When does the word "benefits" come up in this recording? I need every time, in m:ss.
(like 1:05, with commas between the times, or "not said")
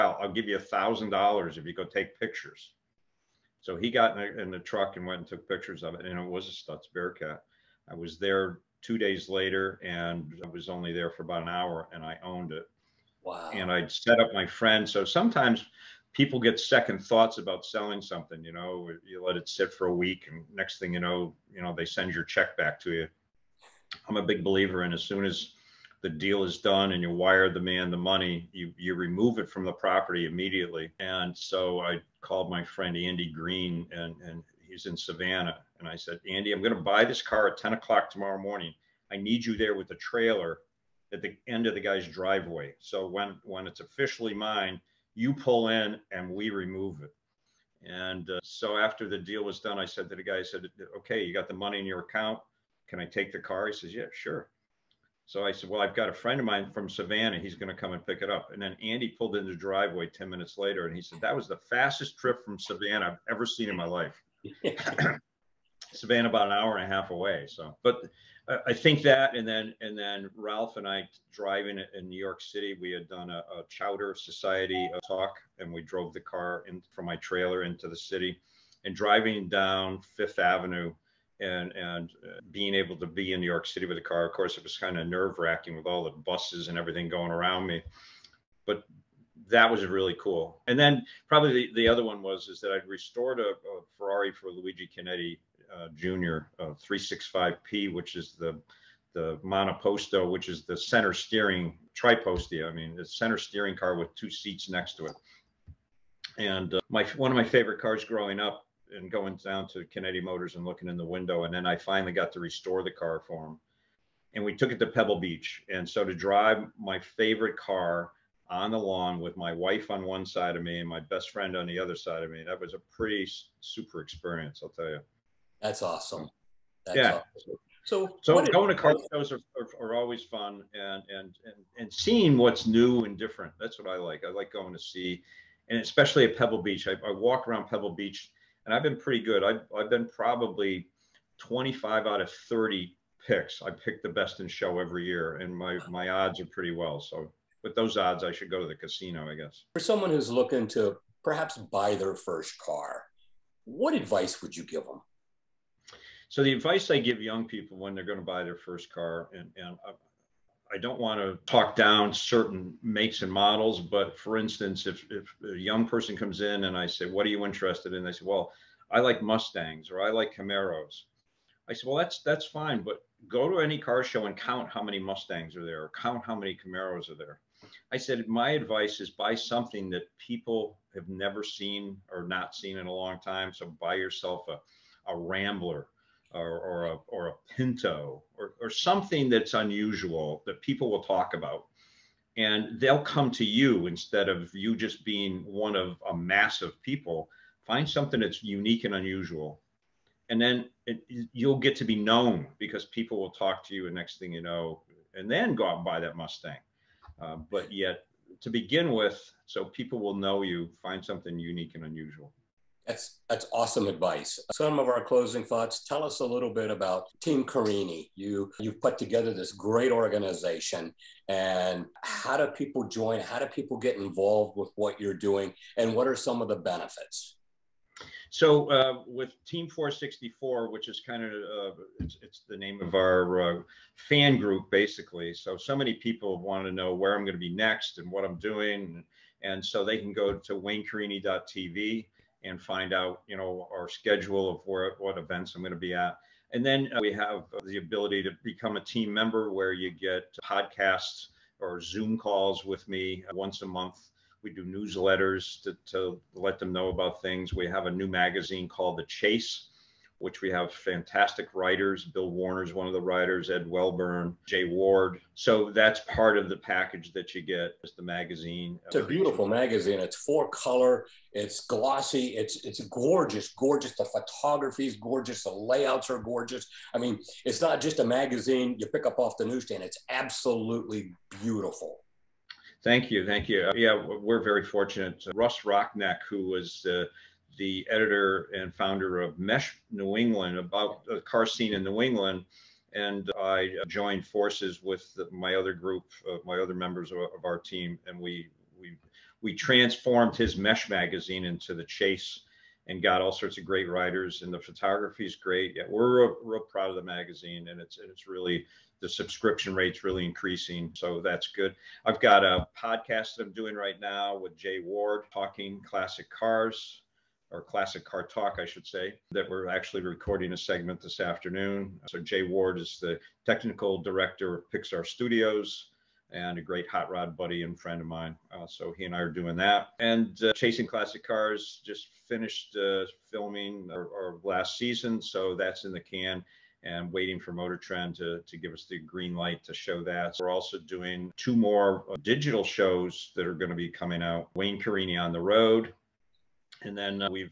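3:46.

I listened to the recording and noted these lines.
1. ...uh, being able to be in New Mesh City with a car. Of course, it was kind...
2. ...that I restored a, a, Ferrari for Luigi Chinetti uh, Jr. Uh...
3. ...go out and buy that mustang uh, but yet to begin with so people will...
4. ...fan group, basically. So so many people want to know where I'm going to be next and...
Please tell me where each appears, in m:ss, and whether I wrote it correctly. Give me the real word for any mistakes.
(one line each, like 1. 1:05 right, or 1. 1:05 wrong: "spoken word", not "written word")
1. 1:22 wrong: "York", not "Mesh"
2. 1:32 right
3. 3:25 right
4. 3:54 right.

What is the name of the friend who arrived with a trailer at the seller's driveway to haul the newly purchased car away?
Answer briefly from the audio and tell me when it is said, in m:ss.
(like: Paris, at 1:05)
Andy Green, at 0:32.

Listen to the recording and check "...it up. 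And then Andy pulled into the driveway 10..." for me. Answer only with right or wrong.
right.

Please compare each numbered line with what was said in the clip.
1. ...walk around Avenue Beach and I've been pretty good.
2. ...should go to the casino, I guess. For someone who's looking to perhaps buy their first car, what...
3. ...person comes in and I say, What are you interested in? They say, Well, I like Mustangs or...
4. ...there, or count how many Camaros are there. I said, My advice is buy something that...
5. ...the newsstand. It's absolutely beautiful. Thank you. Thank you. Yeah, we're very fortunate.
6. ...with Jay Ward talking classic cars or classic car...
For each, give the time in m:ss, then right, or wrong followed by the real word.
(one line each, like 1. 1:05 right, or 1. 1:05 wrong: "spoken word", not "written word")
1. 2:17 wrong: "Pebble", not "Avenue"
2. 2:28 right
3. 2:45 right
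4. 2:55 right
5. 4:39 right
6. 5:14 right.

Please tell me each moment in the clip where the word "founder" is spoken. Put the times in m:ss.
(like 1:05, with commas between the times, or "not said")
4:48.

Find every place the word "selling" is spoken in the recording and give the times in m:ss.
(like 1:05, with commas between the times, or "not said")
0:17.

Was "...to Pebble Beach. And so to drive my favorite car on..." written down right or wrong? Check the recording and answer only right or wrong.
right.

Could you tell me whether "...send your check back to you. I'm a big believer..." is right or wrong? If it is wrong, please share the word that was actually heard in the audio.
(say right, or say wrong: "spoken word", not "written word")
right.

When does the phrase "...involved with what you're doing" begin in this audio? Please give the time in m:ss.
3:43.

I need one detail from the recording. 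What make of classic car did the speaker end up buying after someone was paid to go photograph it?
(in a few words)
Stutz Bearcat.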